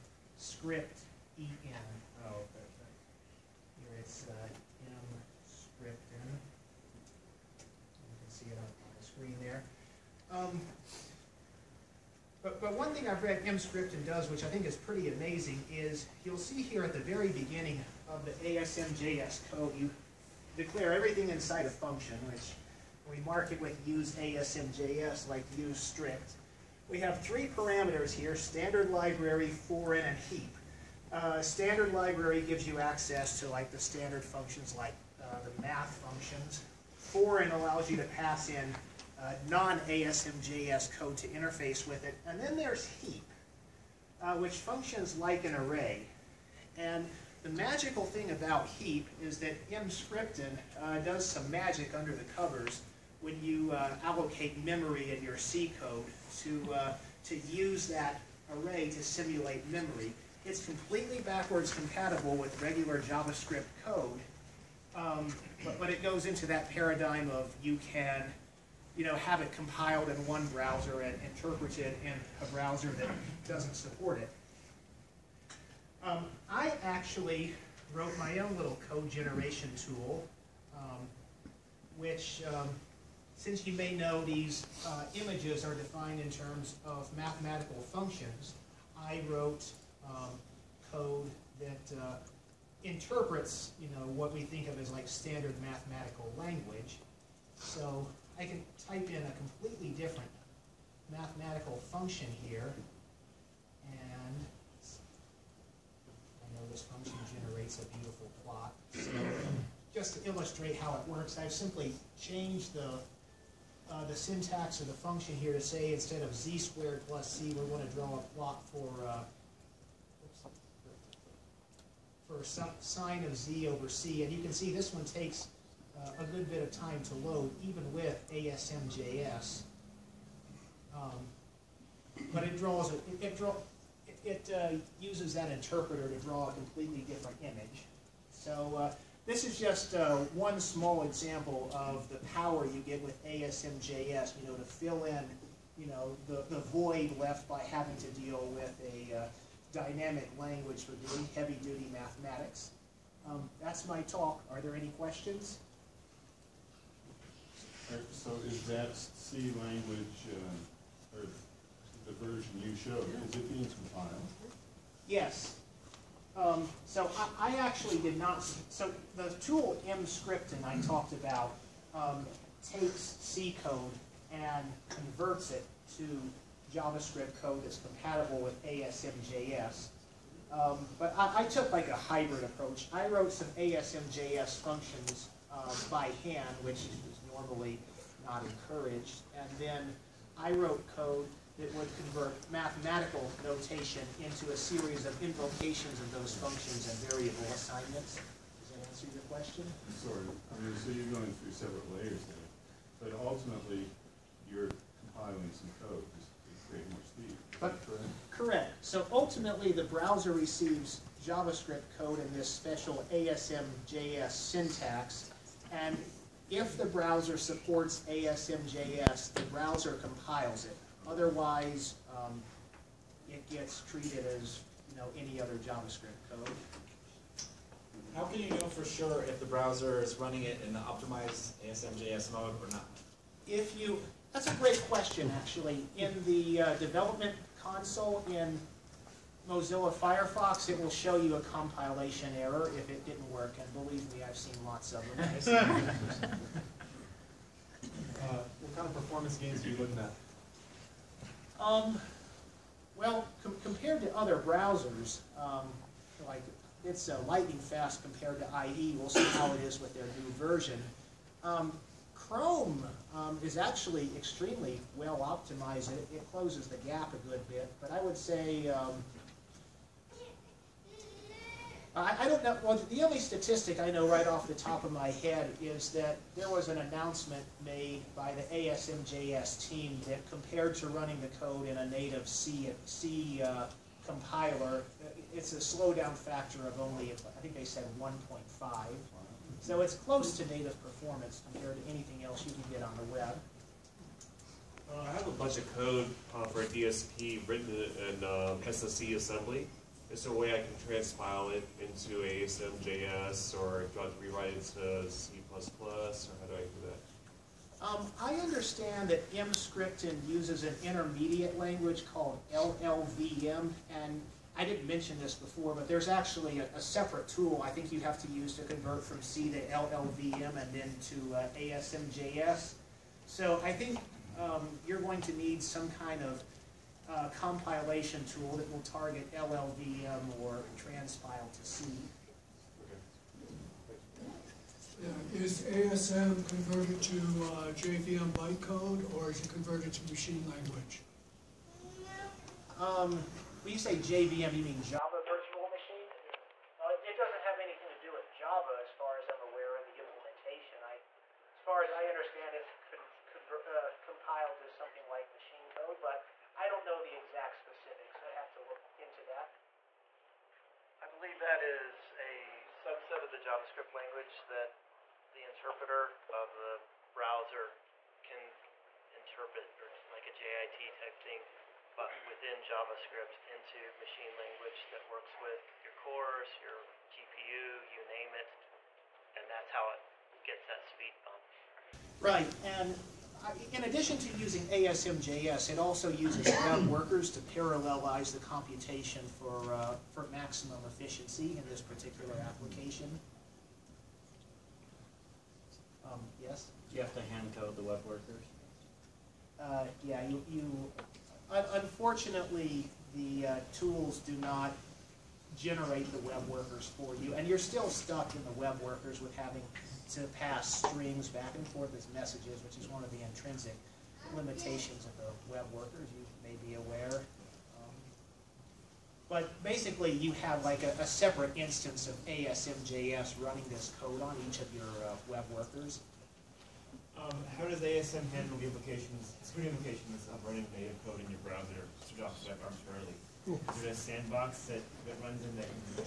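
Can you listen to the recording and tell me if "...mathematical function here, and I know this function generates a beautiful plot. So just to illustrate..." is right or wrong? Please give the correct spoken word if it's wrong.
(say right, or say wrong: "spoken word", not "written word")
right.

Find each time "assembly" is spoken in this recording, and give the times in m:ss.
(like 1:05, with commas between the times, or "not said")
4:59.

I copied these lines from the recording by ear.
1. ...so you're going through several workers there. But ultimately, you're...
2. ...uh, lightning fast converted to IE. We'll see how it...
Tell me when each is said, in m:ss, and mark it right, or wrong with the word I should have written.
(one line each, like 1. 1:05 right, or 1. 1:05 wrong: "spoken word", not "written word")
1. 3:20 wrong: "layers", not "workers"
2. 4:17 wrong: "compared", not "converted".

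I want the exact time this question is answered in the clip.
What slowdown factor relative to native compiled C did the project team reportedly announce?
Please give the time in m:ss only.
4:47.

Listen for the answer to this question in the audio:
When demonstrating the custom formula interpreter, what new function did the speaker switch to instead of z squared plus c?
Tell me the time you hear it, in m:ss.
2:02.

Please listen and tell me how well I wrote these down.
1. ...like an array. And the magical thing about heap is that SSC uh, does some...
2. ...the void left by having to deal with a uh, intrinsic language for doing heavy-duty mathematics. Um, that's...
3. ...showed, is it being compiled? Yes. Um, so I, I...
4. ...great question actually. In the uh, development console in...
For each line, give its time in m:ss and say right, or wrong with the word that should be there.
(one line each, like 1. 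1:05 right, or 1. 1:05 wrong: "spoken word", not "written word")
1. 0:45 wrong: "Emscripten", not "SSC"
2. 2:26 wrong: "dynamic", not "intrinsic"
3. 2:42 right
4. 3:54 right.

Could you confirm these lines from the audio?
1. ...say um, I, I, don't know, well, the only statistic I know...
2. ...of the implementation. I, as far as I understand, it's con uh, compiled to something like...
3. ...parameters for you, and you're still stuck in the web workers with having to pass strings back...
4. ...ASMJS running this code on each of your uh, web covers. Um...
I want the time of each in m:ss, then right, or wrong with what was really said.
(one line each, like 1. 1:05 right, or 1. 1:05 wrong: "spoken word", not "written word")
1. 4:28 right
2. 5:49 right
3. 6:46 wrong: "workers", not "parameters"
4. 7:02 wrong: "workers", not "covers".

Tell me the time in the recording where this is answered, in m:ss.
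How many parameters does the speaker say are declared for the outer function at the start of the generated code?
0:27.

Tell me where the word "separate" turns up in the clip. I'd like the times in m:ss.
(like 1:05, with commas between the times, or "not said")
5:16, 7:01.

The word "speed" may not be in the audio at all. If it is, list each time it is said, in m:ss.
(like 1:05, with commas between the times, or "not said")
3:27, 6:20.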